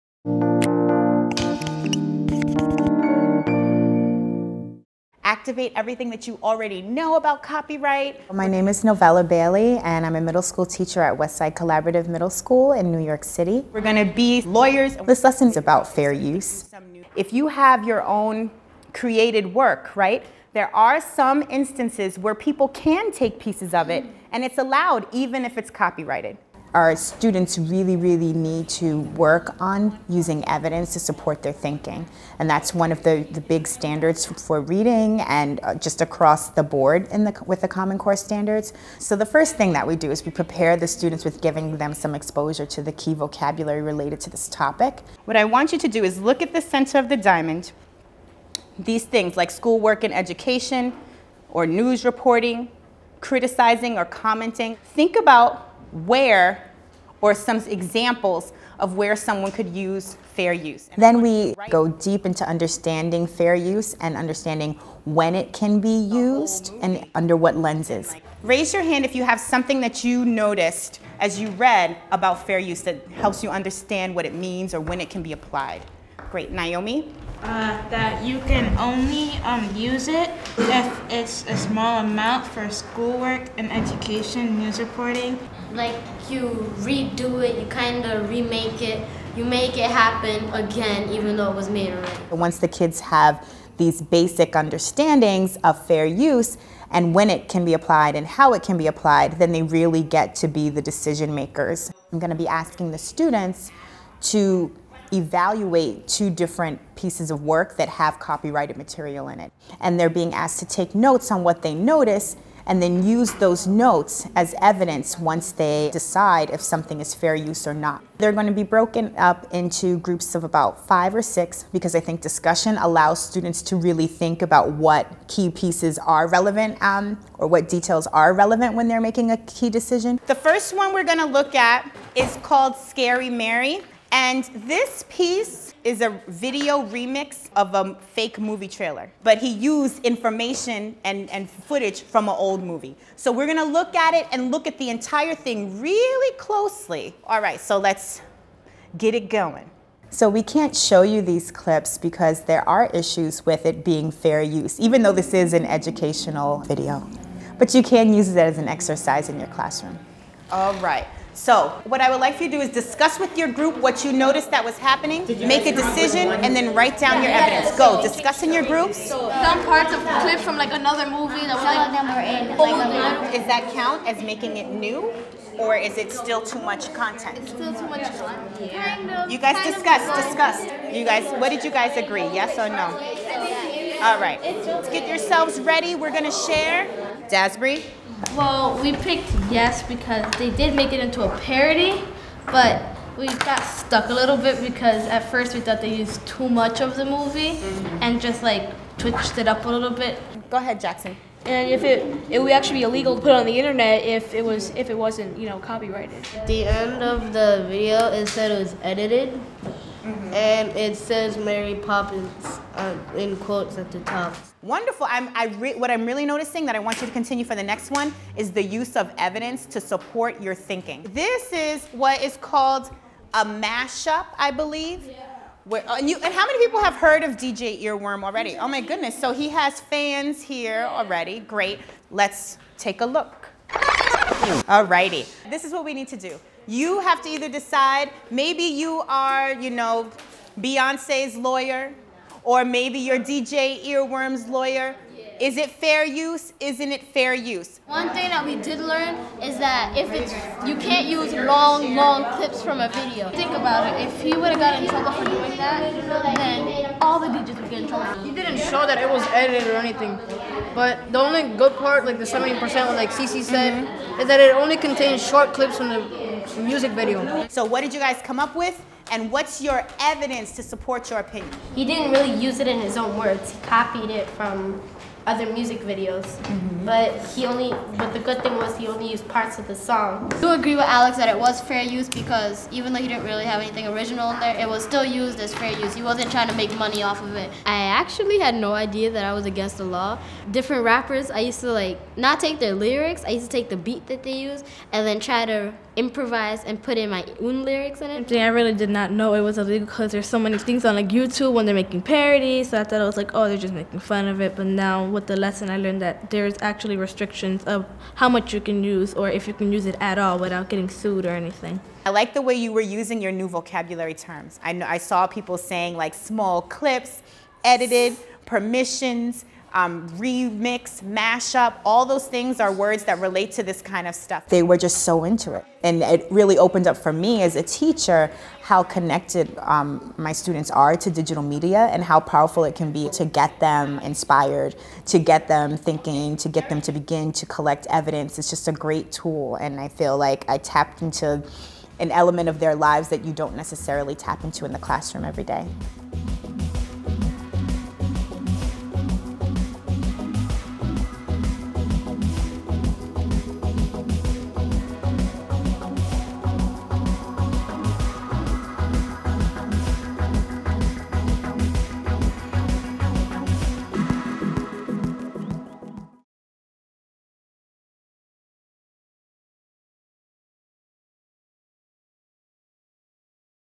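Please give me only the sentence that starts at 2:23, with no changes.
So we're gonna look at it and look at the entire thing really closely.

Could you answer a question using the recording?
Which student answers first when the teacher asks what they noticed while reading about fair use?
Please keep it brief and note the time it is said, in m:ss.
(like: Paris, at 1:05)
Naomi, at 1:16.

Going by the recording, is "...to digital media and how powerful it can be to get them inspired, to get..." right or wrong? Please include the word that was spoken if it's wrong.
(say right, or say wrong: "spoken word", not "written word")
right.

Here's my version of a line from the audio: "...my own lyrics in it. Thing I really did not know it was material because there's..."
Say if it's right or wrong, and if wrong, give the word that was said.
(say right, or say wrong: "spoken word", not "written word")
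wrong: "illegal", not "material".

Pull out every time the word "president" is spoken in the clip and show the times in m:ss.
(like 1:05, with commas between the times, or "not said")
not said.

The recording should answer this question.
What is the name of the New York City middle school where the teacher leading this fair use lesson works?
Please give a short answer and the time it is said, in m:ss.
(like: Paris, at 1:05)
Westside Collaborative Middle School, at 0:11.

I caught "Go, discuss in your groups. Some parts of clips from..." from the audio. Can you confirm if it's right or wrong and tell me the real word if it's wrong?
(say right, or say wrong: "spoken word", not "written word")
right.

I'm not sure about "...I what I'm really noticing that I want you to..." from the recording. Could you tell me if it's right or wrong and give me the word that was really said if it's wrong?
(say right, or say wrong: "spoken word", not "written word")
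right.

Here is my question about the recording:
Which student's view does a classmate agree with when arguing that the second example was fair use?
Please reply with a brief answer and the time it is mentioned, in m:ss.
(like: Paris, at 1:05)
Alex, at 4:40.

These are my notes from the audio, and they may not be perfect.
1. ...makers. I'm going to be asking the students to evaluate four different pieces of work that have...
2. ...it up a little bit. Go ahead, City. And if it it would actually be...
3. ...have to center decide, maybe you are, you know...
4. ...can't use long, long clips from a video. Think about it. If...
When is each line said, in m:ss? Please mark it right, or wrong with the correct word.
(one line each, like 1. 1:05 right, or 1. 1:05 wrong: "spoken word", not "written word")
1. 1:41 wrong: "two", not "four"
2. 3:19 wrong: "Jackson", not "City"
3. 3:57 wrong: "either", not "center"
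4. 4:10 right.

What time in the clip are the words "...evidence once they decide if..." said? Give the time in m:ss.
1:54.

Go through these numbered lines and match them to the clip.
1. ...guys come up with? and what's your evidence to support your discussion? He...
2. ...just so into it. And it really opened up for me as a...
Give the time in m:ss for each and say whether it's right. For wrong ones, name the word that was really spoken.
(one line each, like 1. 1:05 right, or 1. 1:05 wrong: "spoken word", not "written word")
1. 4:28 wrong: "opinion", not "discussion"
2. 5:24 right.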